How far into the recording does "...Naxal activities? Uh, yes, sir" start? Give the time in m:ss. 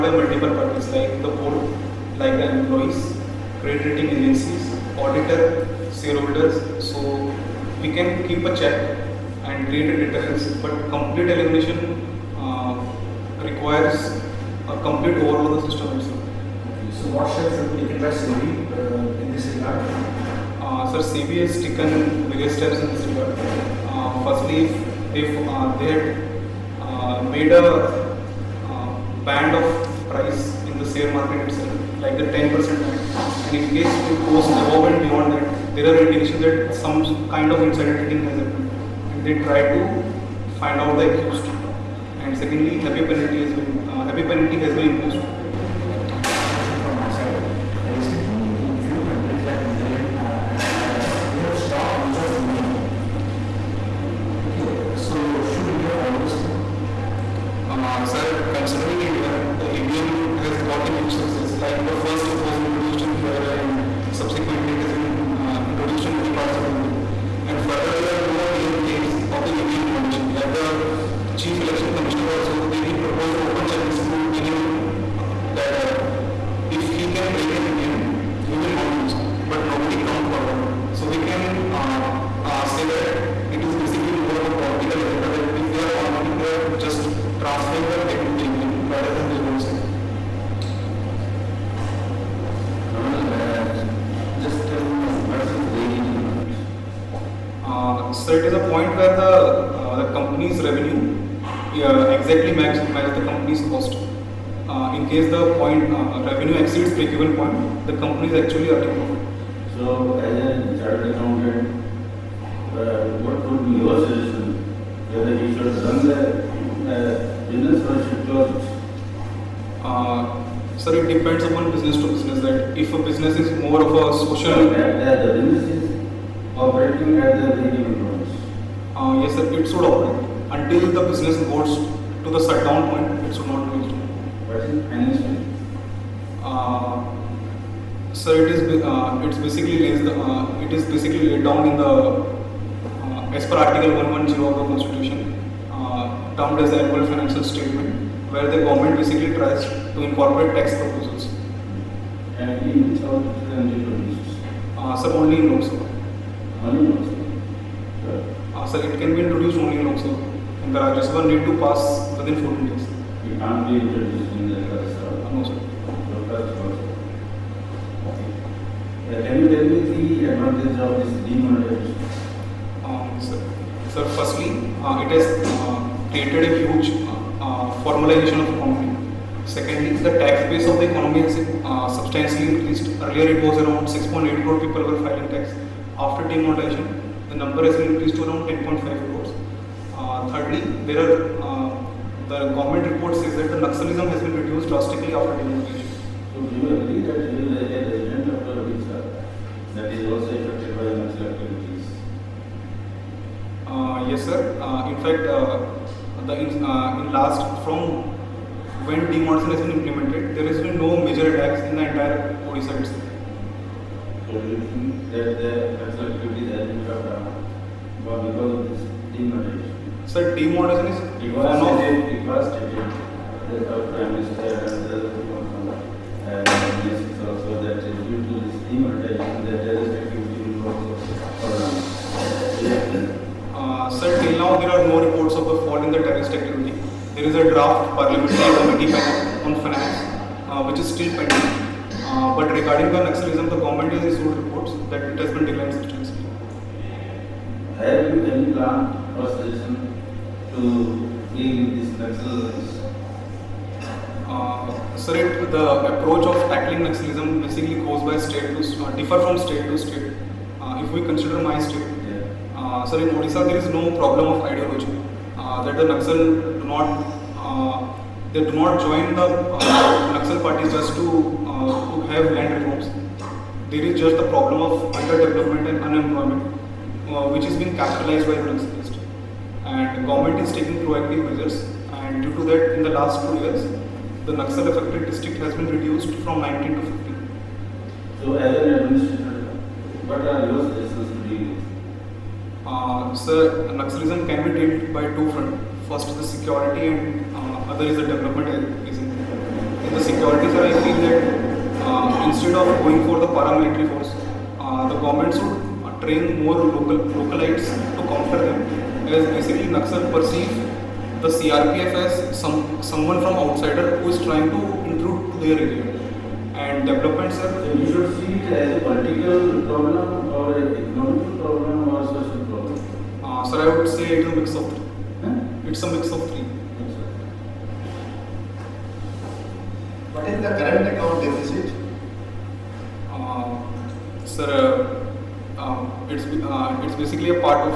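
3:21.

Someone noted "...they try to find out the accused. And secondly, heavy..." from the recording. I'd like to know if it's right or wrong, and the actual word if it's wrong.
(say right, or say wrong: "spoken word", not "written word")
right.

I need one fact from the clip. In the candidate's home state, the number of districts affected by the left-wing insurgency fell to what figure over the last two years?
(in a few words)
15.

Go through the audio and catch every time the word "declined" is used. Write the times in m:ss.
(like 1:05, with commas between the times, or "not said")
4:05.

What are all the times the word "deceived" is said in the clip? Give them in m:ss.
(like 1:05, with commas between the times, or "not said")
not said.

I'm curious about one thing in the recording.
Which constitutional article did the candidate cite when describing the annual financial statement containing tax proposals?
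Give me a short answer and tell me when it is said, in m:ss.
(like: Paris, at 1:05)
Article 110, at 2:23.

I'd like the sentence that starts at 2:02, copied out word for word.
That if a business is more of a social, that, the business is operating at the breakeven points.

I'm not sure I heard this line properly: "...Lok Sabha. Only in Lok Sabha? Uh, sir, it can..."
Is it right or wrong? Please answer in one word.
right.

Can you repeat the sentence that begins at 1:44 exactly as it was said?
Uh, in case the point uh, revenue exceeds the given point, the company is actually earning profit.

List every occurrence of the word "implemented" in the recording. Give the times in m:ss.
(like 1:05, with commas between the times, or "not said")
3:29.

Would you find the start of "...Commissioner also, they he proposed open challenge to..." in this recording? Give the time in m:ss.
1:11.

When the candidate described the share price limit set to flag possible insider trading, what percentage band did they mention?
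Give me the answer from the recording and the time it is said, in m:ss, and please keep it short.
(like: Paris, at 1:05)
10%, at 0:32.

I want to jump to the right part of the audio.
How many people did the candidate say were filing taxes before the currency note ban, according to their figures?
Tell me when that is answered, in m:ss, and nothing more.
3:03.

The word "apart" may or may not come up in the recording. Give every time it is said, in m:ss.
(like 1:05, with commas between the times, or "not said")
not said.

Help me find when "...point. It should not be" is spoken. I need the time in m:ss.
2:12.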